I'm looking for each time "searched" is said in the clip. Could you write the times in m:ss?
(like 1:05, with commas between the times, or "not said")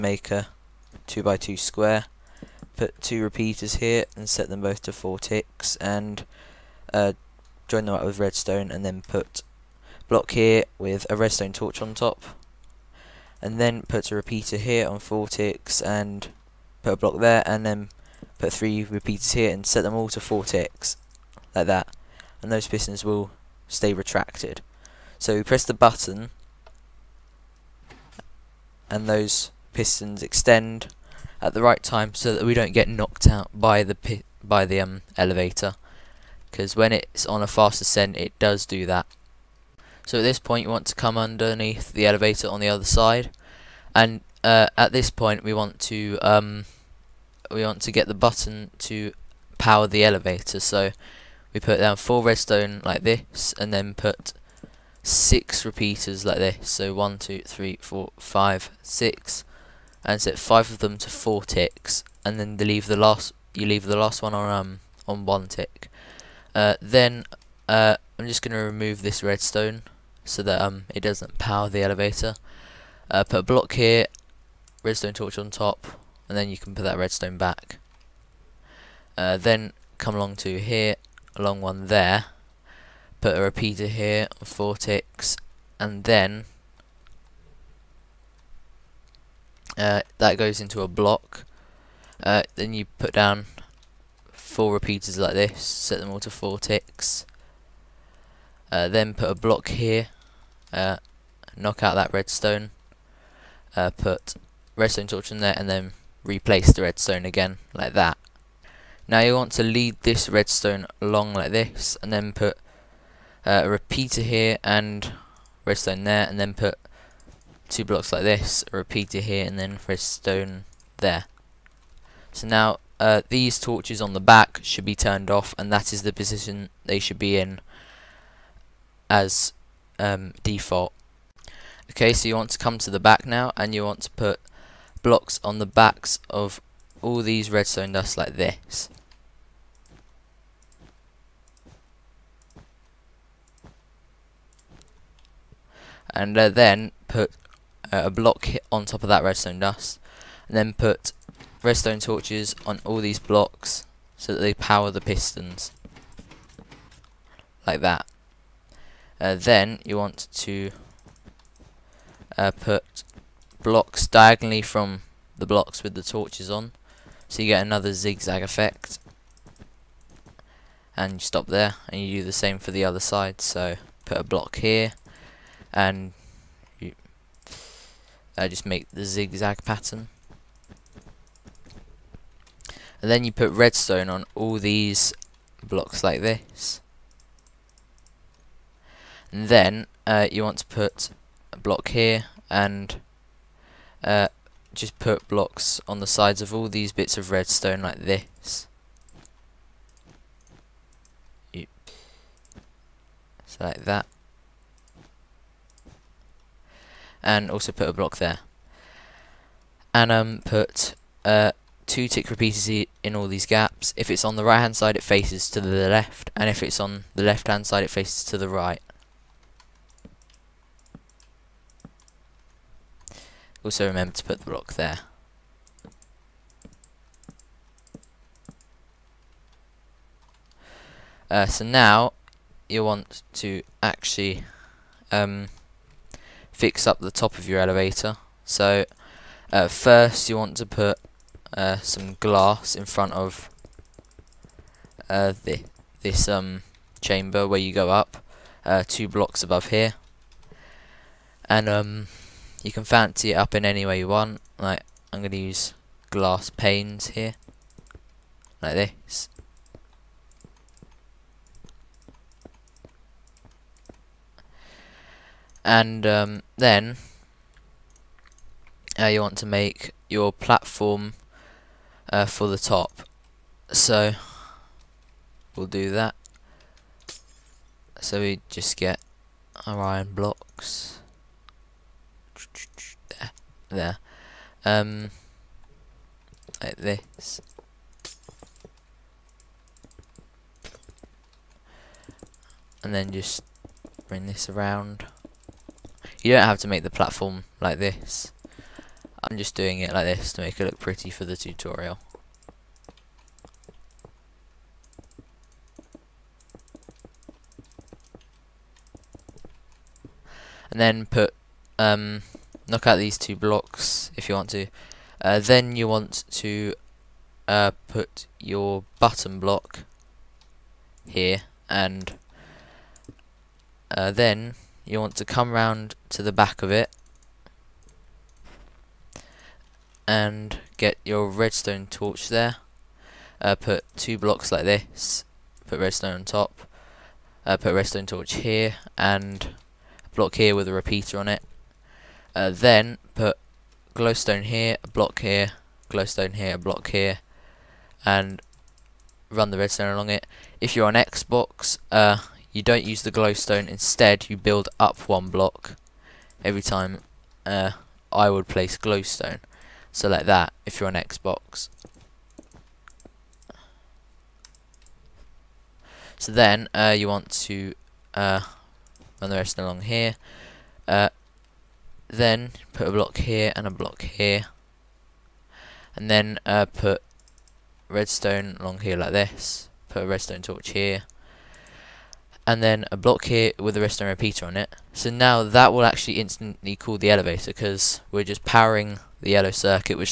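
not said.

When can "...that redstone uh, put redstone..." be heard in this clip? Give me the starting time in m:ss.
1:41.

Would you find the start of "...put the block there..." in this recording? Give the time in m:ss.
3:44.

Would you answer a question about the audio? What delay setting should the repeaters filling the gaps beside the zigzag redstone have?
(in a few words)
2 ticks.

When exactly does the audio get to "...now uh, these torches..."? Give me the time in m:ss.
2:02.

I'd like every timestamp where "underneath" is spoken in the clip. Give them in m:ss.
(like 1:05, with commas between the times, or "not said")
0:41.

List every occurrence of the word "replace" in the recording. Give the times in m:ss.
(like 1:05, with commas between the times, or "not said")
1:46.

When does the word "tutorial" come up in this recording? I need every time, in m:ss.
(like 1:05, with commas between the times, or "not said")
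5:01.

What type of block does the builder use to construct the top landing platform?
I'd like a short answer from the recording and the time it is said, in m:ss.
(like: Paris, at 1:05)
Iron blocks, at 4:39.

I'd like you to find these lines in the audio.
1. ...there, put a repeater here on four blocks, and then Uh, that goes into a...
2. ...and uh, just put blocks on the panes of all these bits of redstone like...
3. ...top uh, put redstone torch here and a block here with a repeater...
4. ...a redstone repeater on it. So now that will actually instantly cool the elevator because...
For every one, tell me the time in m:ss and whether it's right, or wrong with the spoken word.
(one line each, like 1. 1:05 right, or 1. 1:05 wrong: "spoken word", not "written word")
1. 1:21 wrong: "ticks", not "blocks"
2. 3:12 wrong: "sides", not "panes"
3. 5:36 right
4. 6:23 right.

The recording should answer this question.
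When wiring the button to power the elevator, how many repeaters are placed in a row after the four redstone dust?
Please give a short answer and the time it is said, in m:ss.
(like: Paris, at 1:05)
6, at 0:55.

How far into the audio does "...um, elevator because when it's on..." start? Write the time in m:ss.
0:34.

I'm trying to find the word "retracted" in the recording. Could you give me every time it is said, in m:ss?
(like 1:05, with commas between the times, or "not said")
0:23.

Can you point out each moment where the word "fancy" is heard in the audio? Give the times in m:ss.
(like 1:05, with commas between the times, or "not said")
4:12.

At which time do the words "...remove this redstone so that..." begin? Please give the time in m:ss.
1:08.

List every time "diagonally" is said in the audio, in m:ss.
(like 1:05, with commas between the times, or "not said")
2:44.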